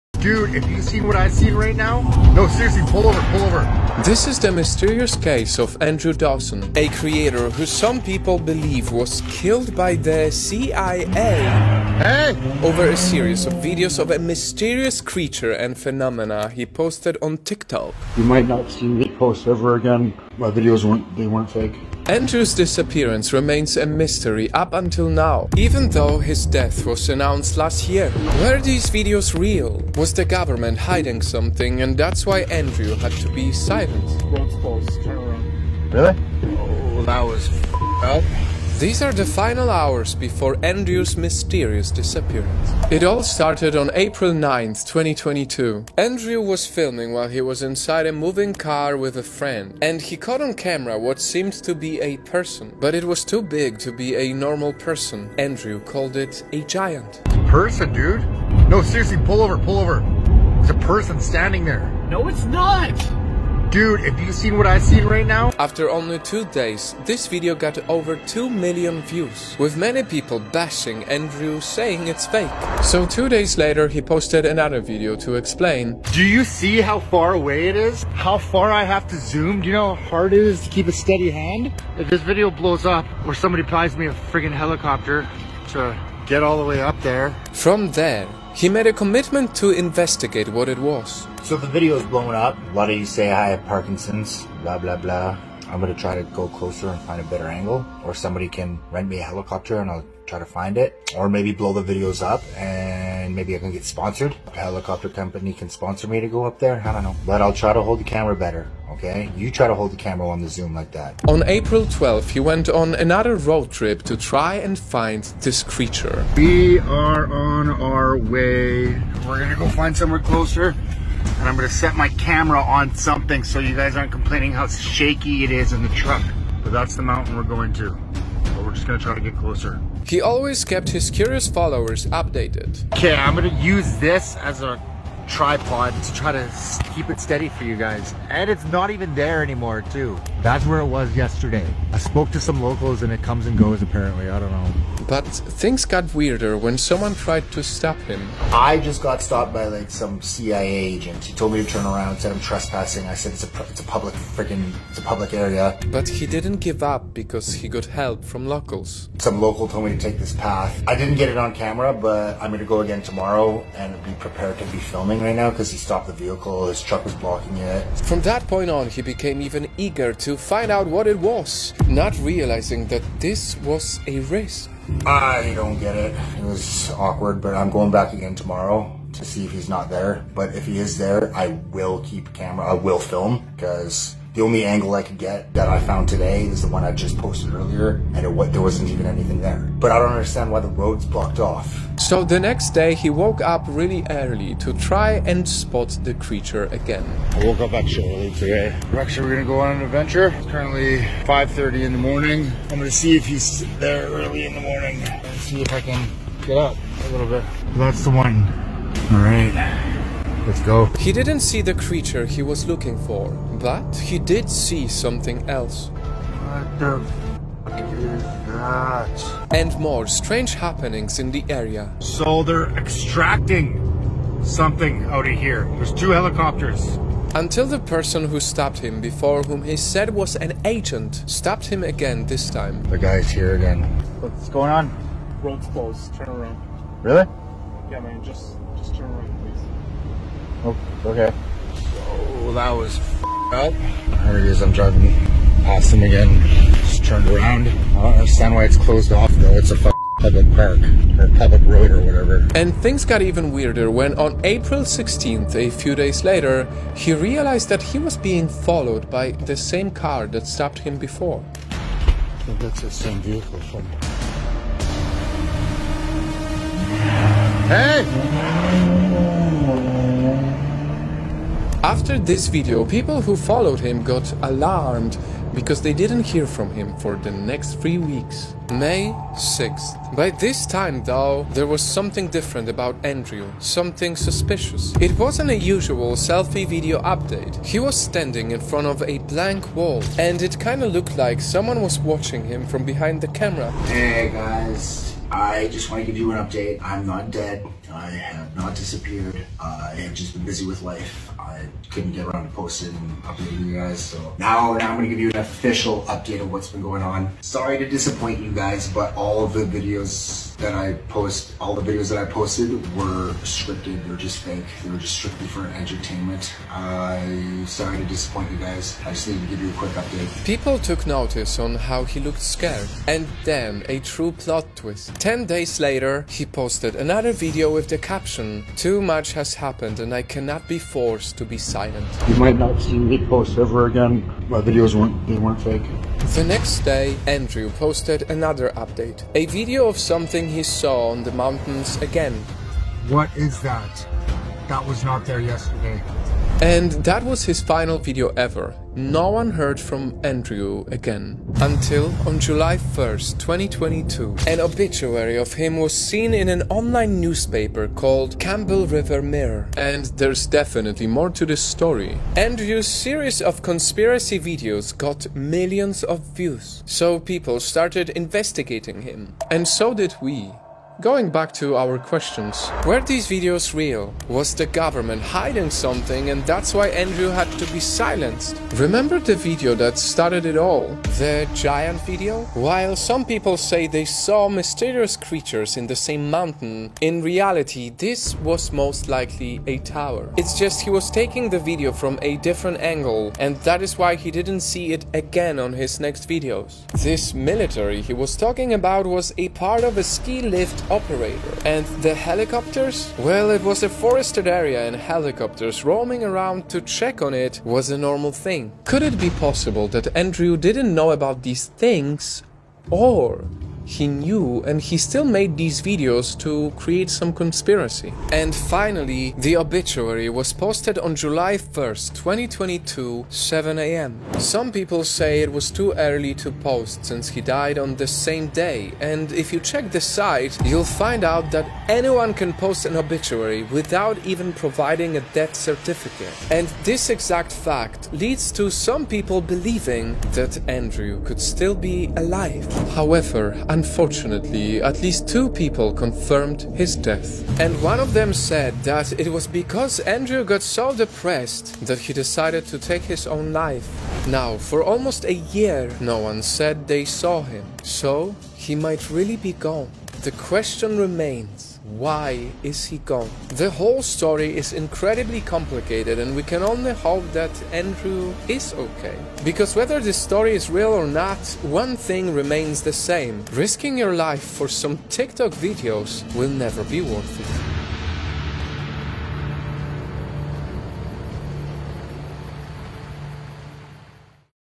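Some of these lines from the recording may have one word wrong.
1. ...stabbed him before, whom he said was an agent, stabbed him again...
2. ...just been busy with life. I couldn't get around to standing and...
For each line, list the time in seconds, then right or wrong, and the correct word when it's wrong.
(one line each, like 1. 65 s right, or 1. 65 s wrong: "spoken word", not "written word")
1. 228 s right
2. 300 s wrong: "posting", not "standing".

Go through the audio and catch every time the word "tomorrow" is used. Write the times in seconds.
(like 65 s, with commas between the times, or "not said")
163 s, 178 s.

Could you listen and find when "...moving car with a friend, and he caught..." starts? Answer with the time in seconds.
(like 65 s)
48 s.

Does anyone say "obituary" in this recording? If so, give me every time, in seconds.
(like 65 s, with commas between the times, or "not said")
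354 s, 419 s, 432 s.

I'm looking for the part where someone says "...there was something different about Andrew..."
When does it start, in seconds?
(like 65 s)
281 s.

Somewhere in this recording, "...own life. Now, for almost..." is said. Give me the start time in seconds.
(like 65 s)
453 s.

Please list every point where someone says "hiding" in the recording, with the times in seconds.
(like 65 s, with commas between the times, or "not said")
30 s, 375 s.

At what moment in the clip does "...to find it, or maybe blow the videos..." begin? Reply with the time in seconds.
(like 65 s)
100 s.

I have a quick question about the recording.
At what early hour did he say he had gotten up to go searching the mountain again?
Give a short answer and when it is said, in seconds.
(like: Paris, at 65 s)
5:30 in the morning, at 201 s.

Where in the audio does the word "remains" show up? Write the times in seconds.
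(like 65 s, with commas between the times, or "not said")
23 s, 460 s, 472 s.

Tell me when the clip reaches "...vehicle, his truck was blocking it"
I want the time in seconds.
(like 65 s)
166 s.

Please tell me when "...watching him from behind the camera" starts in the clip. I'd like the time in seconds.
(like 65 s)
291 s.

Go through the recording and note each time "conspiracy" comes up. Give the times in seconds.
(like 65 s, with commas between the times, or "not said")
363 s, 417 s.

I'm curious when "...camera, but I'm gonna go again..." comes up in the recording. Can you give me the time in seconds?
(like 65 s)
161 s.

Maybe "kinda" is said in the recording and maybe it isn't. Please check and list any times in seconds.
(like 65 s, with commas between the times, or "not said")
290 s.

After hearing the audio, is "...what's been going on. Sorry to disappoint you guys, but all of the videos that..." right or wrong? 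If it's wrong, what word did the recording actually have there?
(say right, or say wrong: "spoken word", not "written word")
right.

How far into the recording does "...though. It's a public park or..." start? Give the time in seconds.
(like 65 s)
249 s.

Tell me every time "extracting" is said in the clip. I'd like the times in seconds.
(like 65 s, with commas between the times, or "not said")
222 s.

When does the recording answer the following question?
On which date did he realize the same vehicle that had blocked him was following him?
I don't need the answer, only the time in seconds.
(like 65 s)
254 s.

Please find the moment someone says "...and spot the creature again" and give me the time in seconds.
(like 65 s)
195 s.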